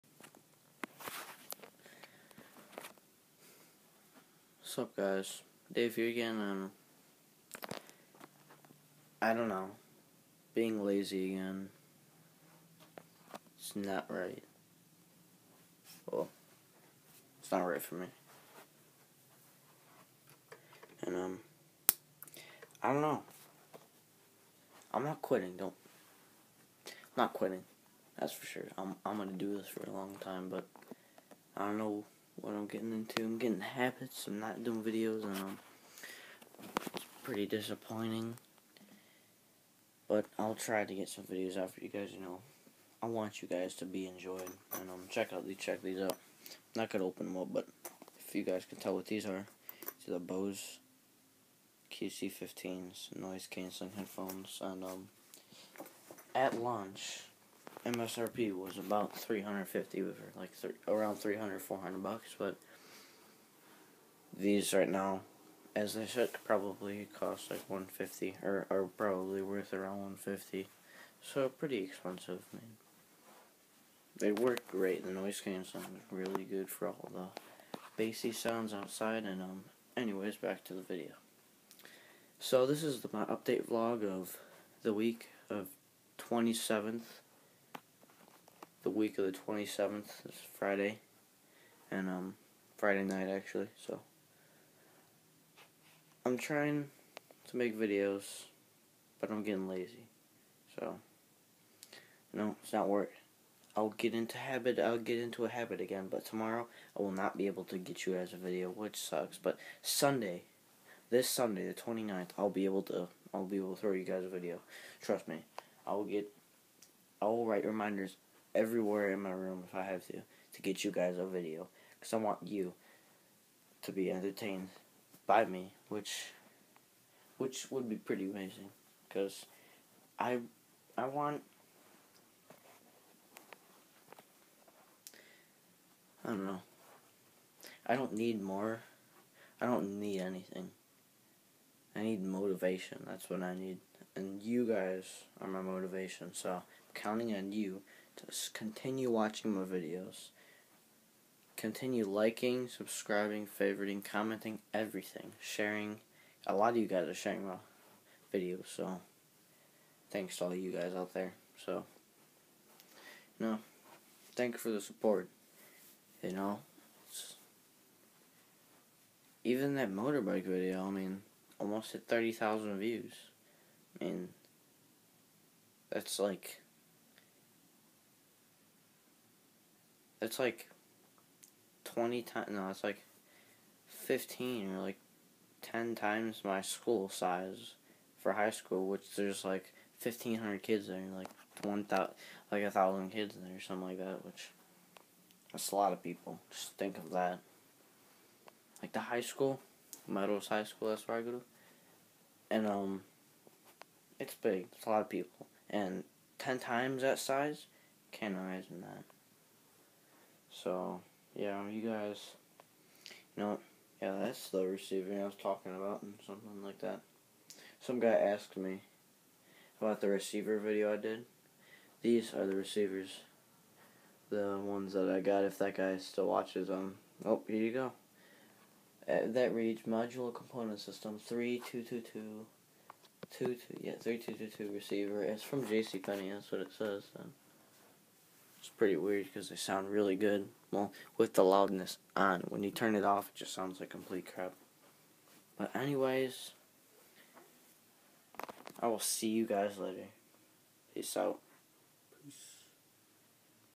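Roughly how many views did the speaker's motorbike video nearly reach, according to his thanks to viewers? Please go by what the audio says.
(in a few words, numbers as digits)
30,000.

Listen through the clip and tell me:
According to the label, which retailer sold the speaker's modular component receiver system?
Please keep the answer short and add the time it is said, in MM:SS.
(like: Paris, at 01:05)
JCPenney, at 03:55.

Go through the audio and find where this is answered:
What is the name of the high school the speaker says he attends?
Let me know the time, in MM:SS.
03:20.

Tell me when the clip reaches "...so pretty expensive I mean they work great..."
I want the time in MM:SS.
01:11.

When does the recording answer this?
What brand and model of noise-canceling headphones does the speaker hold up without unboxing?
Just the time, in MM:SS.
00:50.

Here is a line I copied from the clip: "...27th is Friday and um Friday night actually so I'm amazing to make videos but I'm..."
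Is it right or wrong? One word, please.
wrong.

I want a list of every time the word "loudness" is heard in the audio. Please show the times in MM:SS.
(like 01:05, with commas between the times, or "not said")
04:01.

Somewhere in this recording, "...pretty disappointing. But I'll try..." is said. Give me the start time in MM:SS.
00:37.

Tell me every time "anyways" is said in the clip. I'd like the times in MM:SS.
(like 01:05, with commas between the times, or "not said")
01:19, 04:05.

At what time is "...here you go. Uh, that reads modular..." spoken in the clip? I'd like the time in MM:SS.
03:47.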